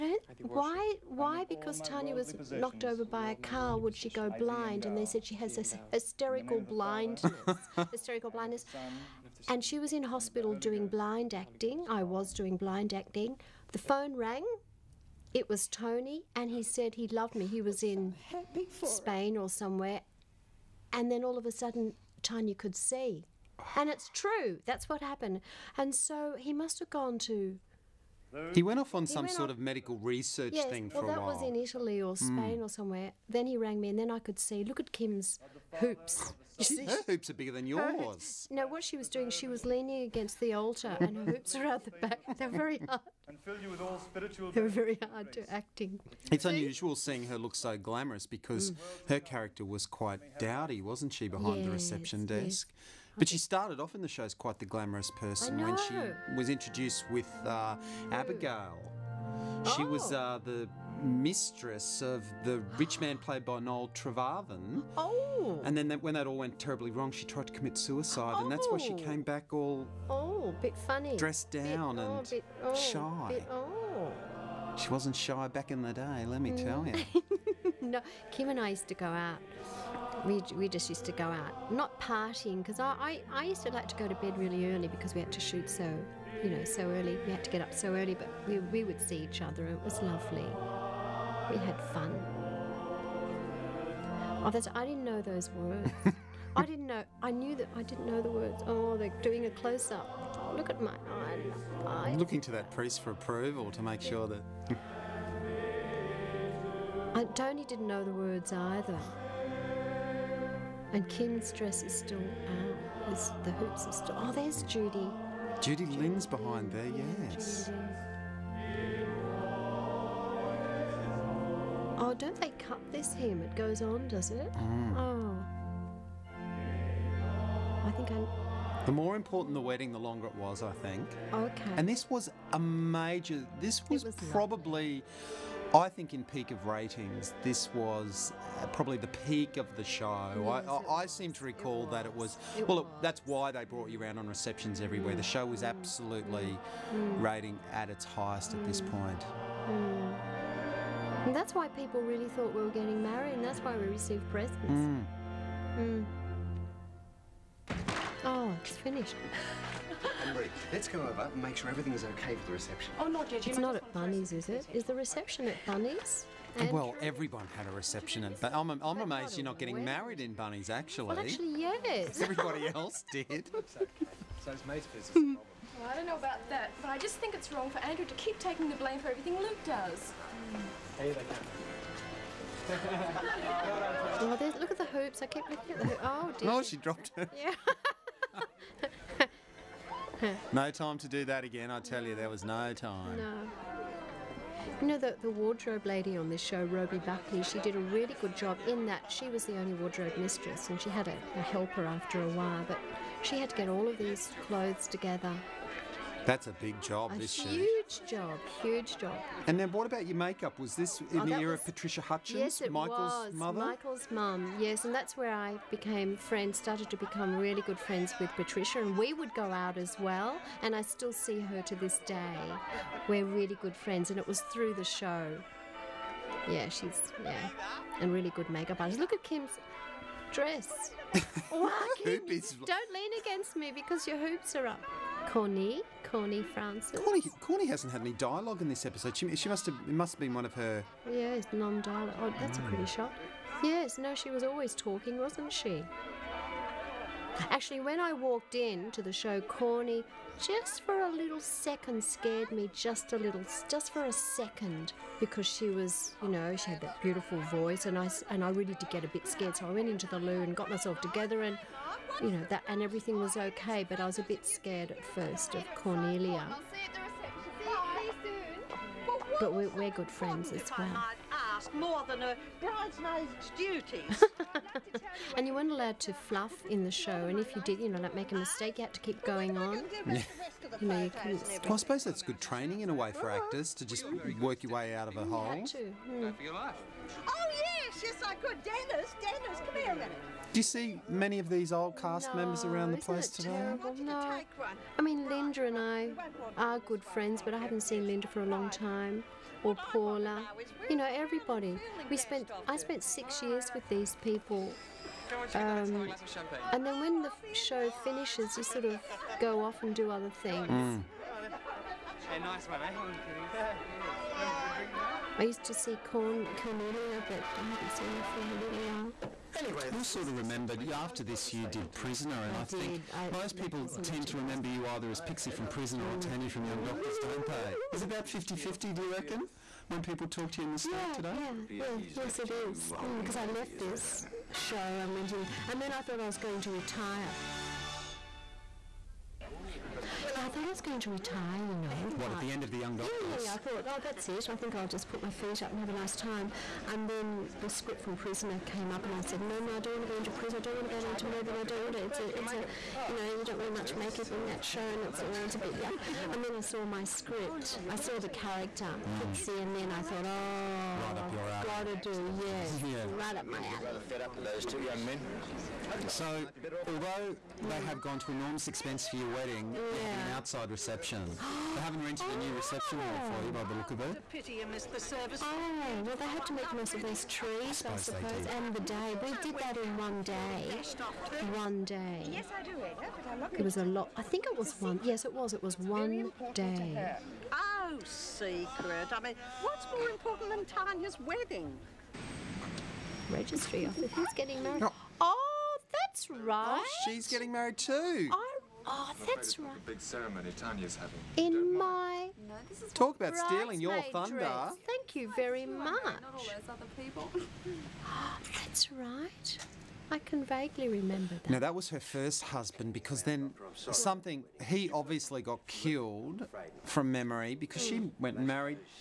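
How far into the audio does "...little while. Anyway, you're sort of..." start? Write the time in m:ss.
5:18.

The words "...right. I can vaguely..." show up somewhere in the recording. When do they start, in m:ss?
6:48.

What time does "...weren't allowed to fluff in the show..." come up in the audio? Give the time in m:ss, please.
4:35.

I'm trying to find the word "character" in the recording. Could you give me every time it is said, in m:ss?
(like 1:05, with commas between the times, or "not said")
0:49, 5:58.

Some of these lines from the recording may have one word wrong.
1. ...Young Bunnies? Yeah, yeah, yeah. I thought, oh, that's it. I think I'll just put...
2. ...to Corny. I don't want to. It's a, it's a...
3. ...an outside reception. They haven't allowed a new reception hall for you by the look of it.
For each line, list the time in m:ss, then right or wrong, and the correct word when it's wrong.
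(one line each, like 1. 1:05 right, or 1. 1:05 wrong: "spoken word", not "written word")
1. 5:42 wrong: "Doctors", not "Bunnies"
2. 5:51 wrong: "Melbourne", not "Corny"
3. 6:10 wrong: "rented", not "allowed".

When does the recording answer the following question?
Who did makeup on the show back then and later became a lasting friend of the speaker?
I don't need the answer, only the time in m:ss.
3:31.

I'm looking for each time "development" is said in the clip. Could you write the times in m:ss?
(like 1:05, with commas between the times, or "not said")
not said.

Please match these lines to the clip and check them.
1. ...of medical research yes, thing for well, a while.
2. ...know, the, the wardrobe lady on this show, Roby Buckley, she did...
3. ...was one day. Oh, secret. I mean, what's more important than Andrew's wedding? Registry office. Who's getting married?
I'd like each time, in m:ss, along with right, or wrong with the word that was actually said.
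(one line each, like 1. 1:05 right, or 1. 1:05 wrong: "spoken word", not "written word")
1. 0:29 right
2. 3:14 right
3. 6:25 wrong: "Tanya", not "Andrew".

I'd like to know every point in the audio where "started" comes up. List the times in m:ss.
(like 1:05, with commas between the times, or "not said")
0:53, 3:36.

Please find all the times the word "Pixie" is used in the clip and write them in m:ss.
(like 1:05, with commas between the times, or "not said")
5:25, 5:59.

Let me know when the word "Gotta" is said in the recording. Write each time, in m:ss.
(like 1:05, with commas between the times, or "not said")
6:01.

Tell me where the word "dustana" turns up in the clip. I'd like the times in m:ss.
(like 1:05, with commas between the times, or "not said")
not said.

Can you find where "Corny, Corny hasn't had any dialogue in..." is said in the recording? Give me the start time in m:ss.
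3:57.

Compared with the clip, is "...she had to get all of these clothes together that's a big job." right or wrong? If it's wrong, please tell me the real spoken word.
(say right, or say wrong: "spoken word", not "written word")
right.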